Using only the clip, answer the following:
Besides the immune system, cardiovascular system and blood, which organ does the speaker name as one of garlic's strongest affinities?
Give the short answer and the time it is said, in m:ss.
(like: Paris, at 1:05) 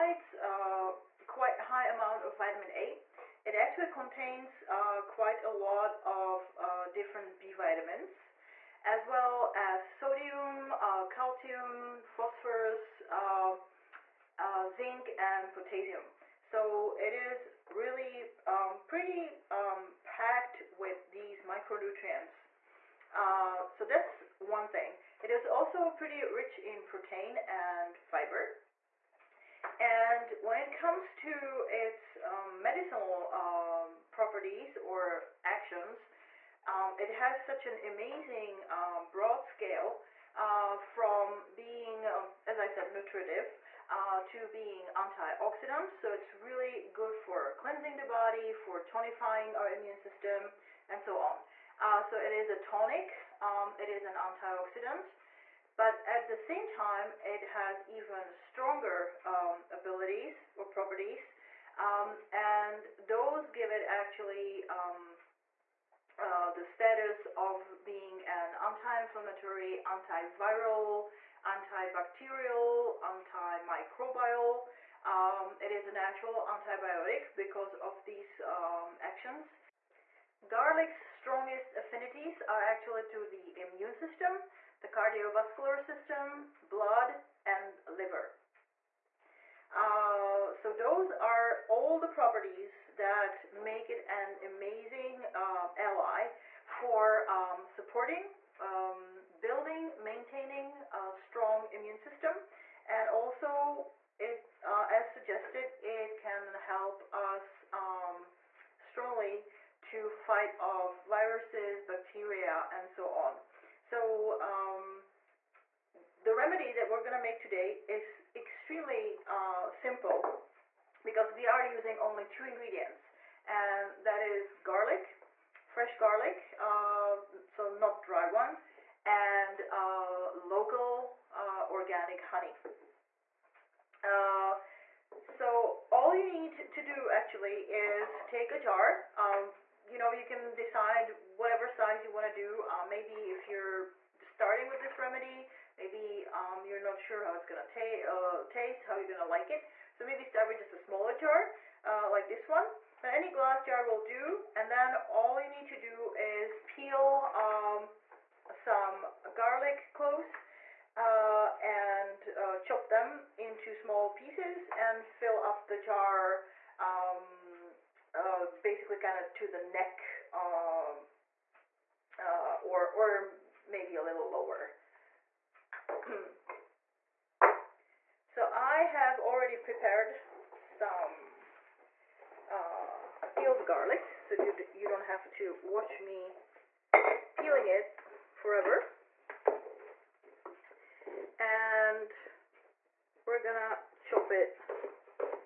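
liver, at 1:27.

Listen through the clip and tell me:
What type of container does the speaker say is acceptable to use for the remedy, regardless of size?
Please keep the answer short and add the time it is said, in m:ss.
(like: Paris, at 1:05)
any glass jar, at 2:33.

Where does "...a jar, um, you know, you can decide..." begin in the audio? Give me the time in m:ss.
2:18.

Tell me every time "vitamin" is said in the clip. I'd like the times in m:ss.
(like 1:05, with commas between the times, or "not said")
0:02, 0:07.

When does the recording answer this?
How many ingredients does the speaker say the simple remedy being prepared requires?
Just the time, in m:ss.
2:02.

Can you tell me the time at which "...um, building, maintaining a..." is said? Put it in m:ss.
1:38.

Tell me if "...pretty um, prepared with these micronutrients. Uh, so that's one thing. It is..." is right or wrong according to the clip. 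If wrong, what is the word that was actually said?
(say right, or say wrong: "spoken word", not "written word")
wrong: "packed", not "prepared".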